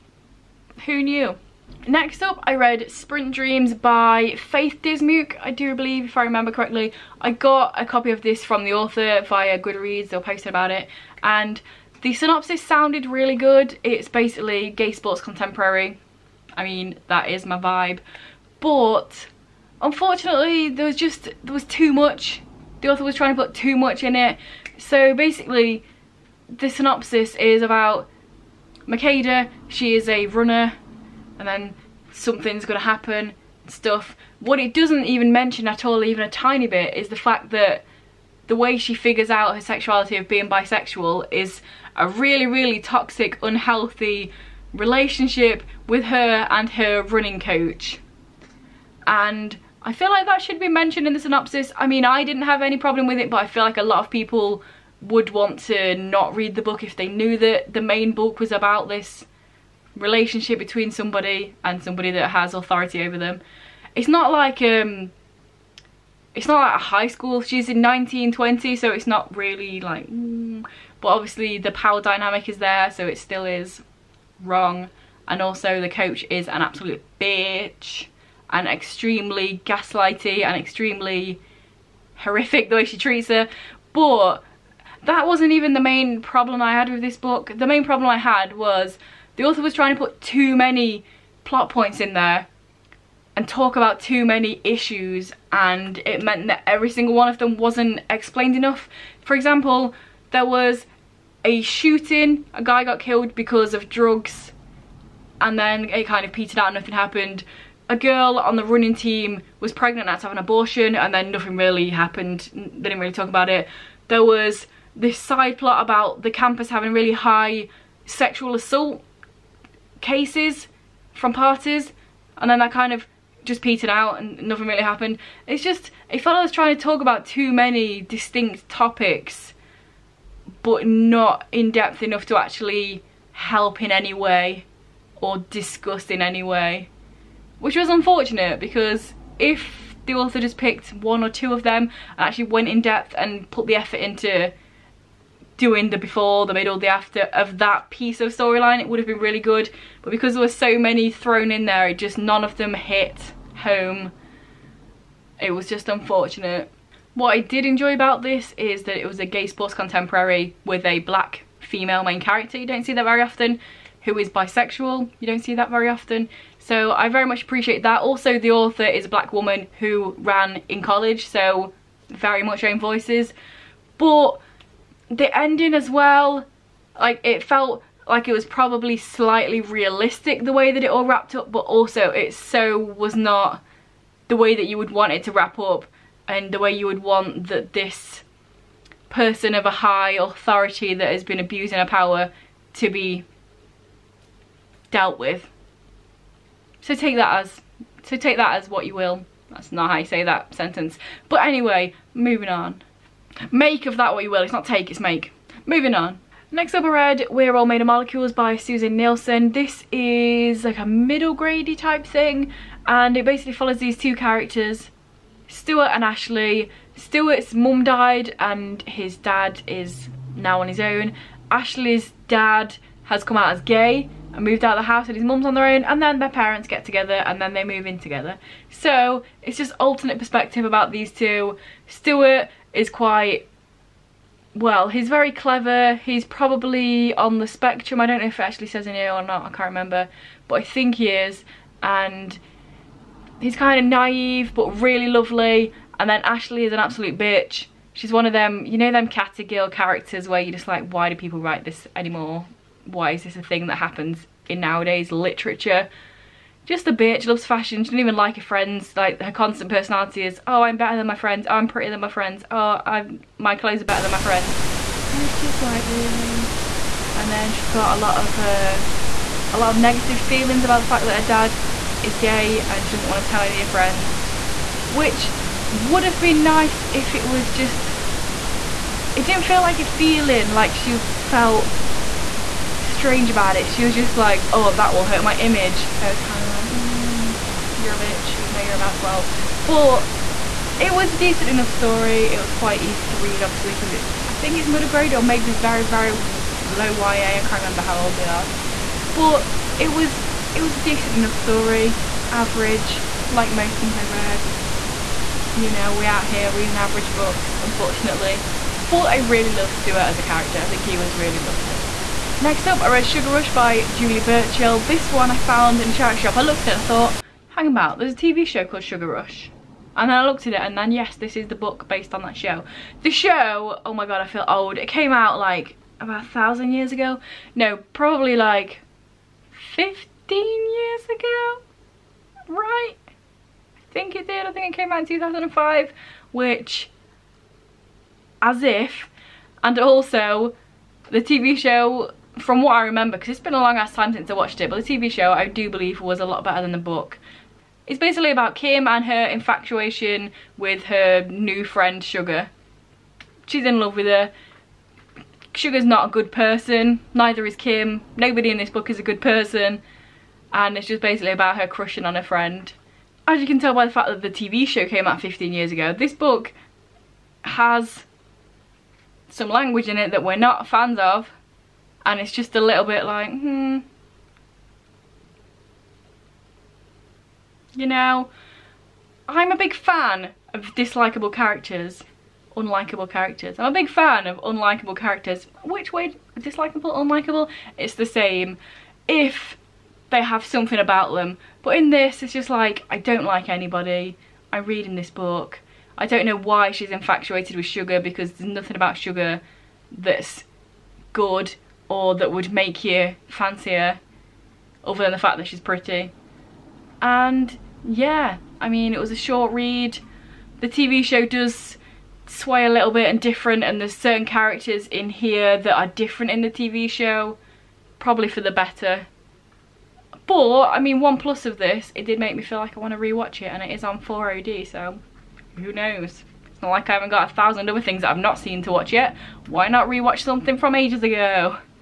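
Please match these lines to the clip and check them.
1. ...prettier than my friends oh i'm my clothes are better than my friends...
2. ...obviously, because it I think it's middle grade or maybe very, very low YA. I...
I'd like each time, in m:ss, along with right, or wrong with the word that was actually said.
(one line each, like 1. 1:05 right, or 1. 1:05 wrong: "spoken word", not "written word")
1. 4:21 right
2. 4:53 right.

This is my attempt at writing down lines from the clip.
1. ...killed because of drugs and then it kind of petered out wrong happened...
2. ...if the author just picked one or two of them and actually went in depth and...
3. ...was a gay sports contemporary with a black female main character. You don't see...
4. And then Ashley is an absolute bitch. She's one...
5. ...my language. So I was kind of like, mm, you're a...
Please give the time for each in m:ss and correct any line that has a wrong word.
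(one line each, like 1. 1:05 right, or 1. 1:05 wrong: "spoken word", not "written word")
1. 1:42 wrong: "nothing", not "wrong"
2. 2:19 right
3. 2:39 right
4. 4:05 right
5. 4:45 wrong: "image", not "language".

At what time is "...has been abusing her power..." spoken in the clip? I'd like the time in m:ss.
3:11.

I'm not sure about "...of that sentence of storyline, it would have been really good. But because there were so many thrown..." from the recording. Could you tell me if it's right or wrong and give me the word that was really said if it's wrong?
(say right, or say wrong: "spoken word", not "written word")
wrong: "piece", not "sentence".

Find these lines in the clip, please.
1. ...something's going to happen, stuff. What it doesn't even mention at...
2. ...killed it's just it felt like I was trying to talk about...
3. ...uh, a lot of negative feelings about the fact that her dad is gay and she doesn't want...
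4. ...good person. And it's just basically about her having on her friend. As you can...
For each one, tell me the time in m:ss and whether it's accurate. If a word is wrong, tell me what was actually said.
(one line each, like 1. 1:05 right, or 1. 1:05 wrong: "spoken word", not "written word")
1. 0:32 right
2. 2:04 wrong: "happened", not "killed"
3. 4:28 right
4. 5:59 wrong: "crushing", not "having".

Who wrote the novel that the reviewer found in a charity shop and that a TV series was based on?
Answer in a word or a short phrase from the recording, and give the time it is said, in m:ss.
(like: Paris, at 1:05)
Julie Burchill, at 5:13.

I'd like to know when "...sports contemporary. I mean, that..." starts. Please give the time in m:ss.
0:14.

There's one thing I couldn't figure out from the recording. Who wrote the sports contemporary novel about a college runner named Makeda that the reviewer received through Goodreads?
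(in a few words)
Faith Dismuke.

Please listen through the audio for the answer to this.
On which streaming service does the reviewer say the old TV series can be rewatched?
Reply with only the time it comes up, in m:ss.
7:04.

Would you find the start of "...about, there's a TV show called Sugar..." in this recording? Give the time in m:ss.
5:17.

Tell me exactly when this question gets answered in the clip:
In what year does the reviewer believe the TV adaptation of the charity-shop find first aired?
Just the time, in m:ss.
5:35.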